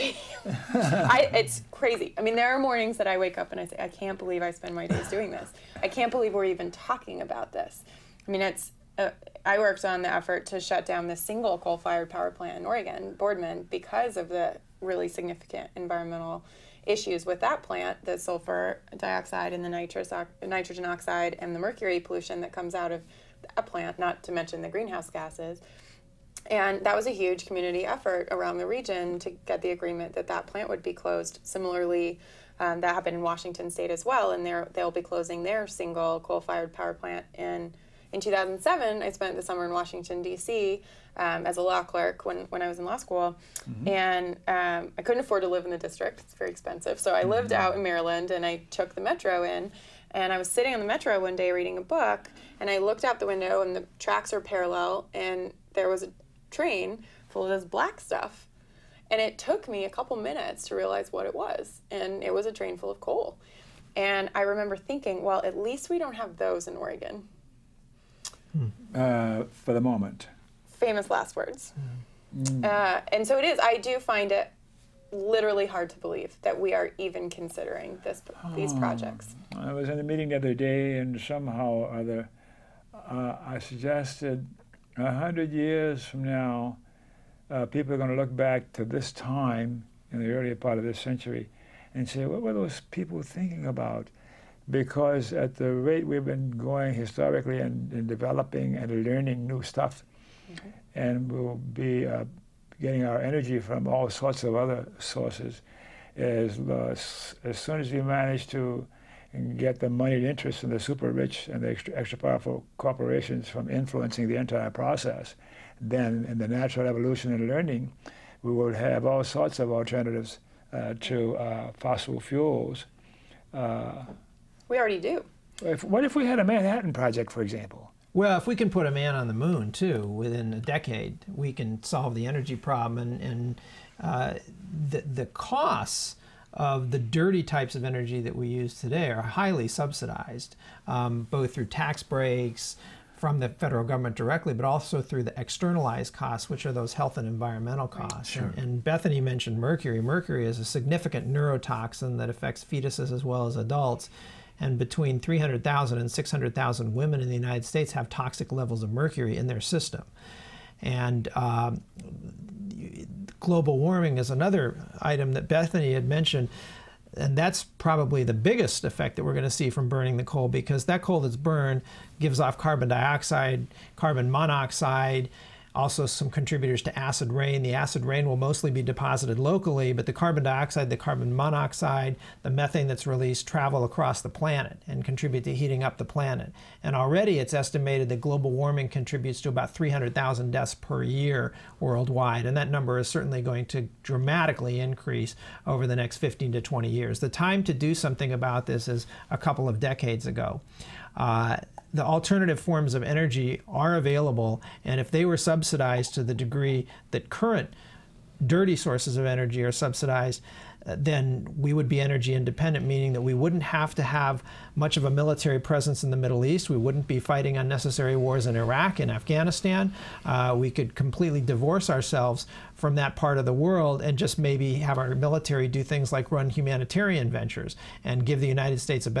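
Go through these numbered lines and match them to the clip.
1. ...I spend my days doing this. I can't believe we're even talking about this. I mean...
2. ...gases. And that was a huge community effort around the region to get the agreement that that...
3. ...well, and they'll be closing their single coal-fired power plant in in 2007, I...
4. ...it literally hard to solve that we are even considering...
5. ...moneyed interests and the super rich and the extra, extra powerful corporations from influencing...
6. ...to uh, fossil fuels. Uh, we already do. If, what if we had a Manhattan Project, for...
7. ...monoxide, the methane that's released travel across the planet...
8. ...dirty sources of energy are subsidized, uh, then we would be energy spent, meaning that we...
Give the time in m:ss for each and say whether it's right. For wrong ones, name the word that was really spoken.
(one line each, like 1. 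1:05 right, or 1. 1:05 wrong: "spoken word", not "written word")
1. 0:04 right
2. 0:25 right
3. 0:34 right
4. 1:14 wrong: "believe", not "solve"
5. 1:49 right
6. 2:00 right
7. 3:01 right
8. 3:28 wrong: "independent", not "spent".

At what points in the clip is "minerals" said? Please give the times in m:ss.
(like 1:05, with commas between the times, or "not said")
not said.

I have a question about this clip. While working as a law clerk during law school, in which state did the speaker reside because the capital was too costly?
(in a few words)
Maryland.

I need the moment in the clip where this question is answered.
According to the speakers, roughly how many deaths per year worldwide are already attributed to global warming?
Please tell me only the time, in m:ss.
3:09.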